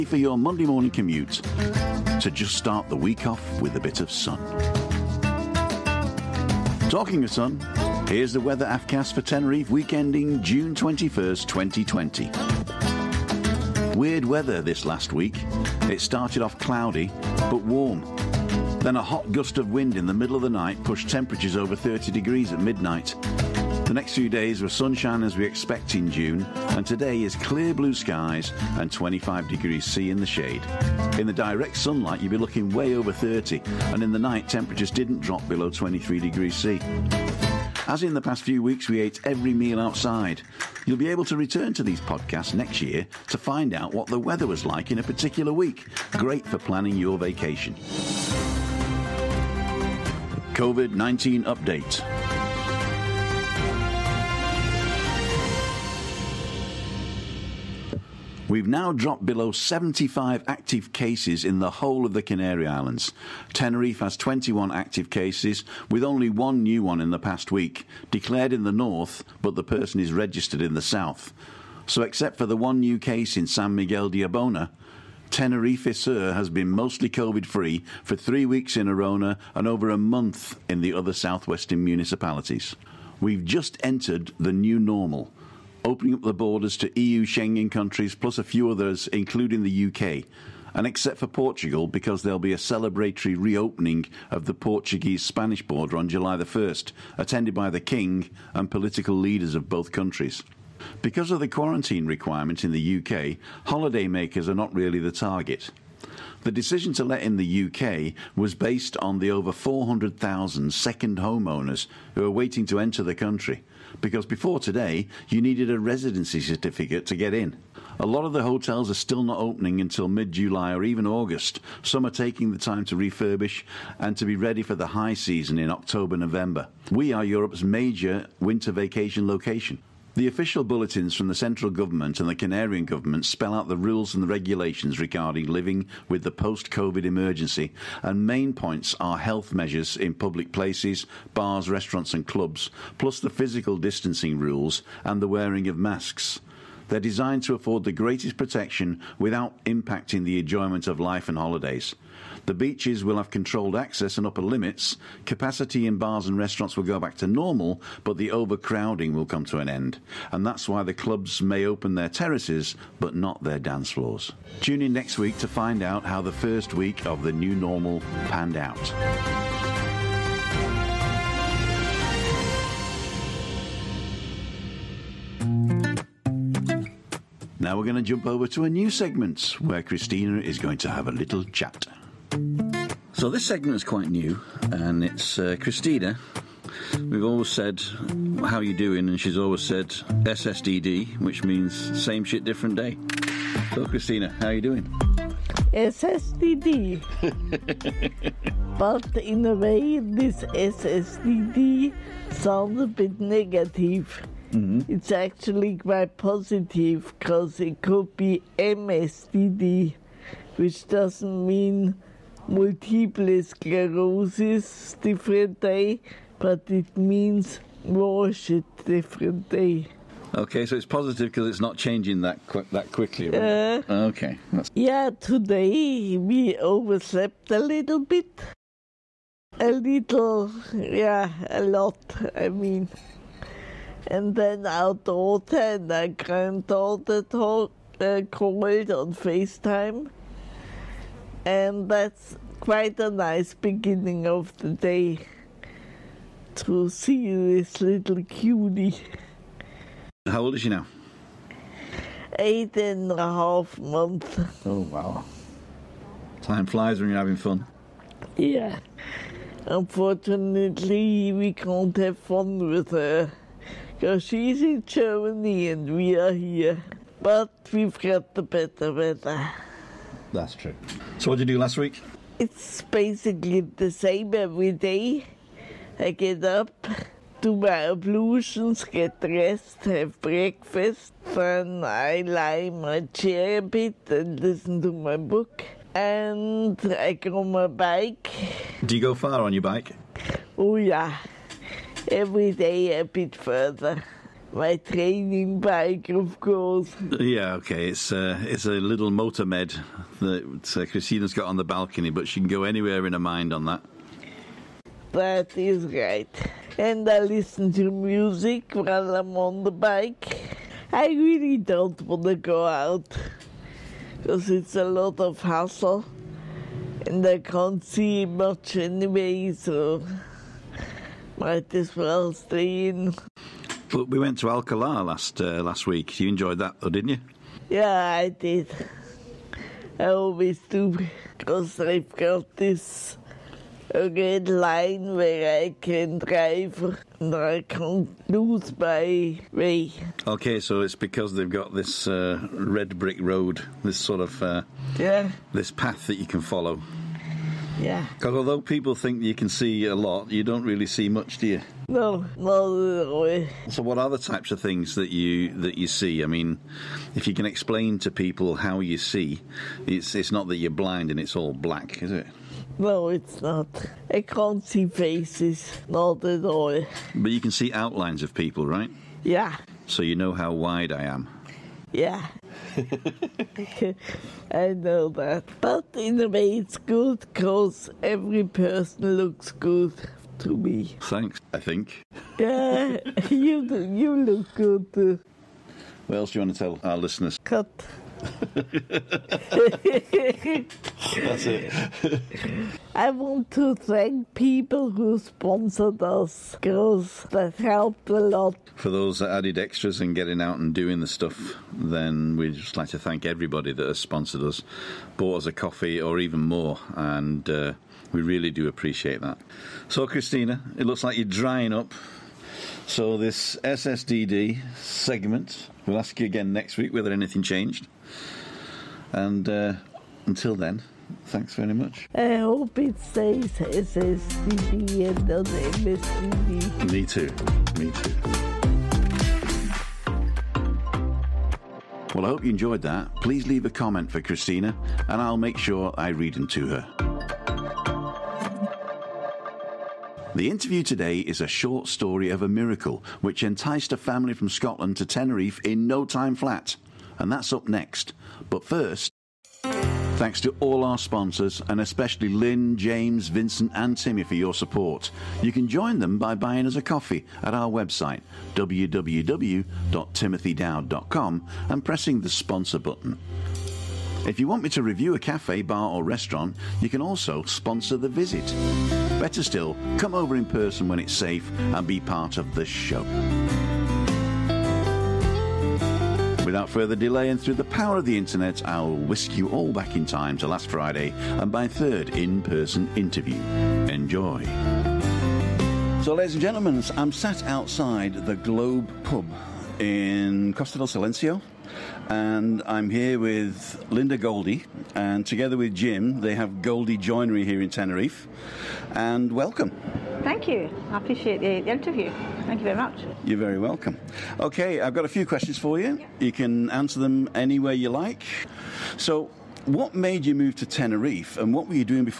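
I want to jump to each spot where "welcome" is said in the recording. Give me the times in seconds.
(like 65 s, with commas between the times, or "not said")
499 s, 503 s.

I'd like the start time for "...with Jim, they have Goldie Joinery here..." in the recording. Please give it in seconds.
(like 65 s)
495 s.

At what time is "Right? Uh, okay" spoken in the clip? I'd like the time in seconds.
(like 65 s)
223 s.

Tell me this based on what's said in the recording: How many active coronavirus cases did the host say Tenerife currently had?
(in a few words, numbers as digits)
21.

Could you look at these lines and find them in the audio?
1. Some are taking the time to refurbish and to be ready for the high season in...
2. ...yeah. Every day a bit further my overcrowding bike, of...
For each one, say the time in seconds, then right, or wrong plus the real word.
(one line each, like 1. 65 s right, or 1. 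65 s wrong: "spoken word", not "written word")
1. 121 s right
2. 290 s wrong: "training", not "overcrowding".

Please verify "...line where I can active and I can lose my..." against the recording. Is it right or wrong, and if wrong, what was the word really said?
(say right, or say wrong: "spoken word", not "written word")
wrong: "drive", not "active".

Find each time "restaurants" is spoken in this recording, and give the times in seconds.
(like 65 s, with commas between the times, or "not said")
141 s, 156 s, 466 s.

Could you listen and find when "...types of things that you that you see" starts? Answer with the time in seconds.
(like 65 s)
354 s.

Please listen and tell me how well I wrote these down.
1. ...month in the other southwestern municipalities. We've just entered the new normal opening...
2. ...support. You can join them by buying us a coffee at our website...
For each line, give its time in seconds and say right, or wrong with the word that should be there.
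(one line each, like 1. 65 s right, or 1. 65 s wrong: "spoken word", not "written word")
1. 79 s right
2. 454 s right.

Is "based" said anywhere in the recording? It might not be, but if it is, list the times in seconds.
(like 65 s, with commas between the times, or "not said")
108 s.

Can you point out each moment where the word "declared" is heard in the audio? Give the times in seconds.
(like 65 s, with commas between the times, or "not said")
68 s.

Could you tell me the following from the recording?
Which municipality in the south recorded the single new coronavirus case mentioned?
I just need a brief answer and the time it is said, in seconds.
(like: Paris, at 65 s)
San Miguel de Abona, at 73 s.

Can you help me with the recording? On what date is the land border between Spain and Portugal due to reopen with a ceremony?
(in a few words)
July 1st.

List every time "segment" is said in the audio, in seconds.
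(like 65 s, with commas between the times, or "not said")
178 s, 183 s, 414 s.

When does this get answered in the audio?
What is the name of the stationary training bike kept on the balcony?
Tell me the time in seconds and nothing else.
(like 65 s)
299 s.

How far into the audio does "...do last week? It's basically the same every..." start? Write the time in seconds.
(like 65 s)
271 s.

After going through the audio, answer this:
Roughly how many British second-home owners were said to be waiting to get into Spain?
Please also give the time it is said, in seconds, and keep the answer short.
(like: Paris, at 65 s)
400,000, at 109 s.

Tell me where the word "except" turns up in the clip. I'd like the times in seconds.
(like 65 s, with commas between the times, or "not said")
72 s, 90 s.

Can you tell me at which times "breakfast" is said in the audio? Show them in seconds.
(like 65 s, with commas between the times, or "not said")
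280 s.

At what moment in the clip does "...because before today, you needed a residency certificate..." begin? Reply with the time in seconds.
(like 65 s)
114 s.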